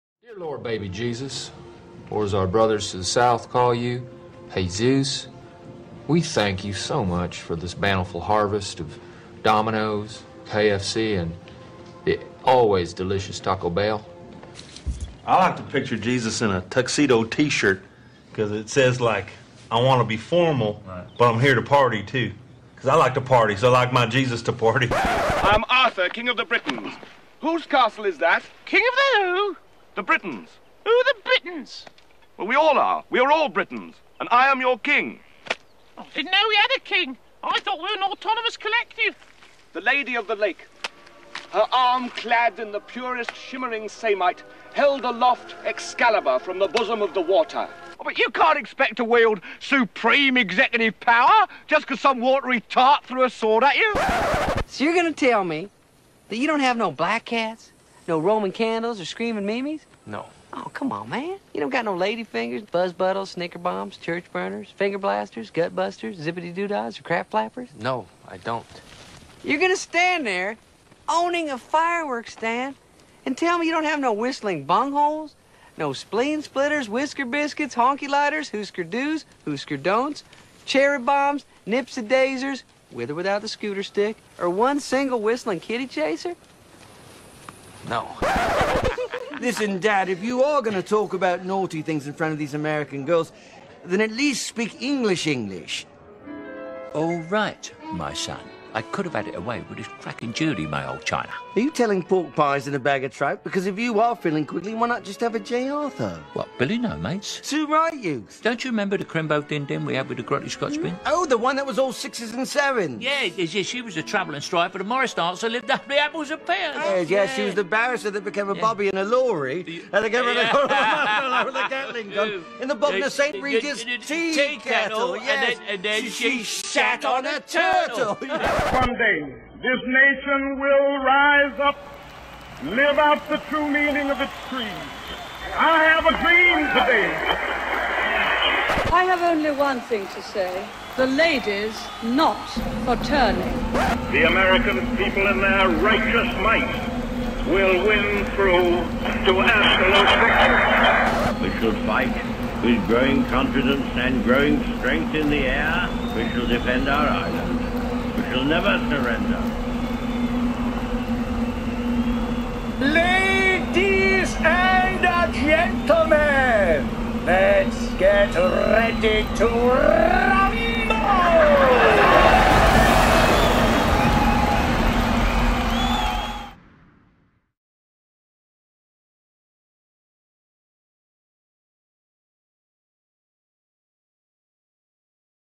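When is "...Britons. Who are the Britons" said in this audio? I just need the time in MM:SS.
00:30.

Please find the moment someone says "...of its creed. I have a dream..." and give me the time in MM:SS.
02:14.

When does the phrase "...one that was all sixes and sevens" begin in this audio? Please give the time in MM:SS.
01:51.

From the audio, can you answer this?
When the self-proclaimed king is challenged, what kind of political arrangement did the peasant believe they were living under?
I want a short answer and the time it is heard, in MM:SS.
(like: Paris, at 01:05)
autonomous collective, at 00:38.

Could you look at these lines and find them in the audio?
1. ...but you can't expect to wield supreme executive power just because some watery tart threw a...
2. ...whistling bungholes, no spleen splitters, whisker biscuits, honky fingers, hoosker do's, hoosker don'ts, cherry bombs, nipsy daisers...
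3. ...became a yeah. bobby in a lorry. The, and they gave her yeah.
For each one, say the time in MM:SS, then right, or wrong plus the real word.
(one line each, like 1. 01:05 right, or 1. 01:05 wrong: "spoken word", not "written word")
1. 00:48 right
2. 01:14 wrong: "lighters", not "fingers"
3. 01:58 right.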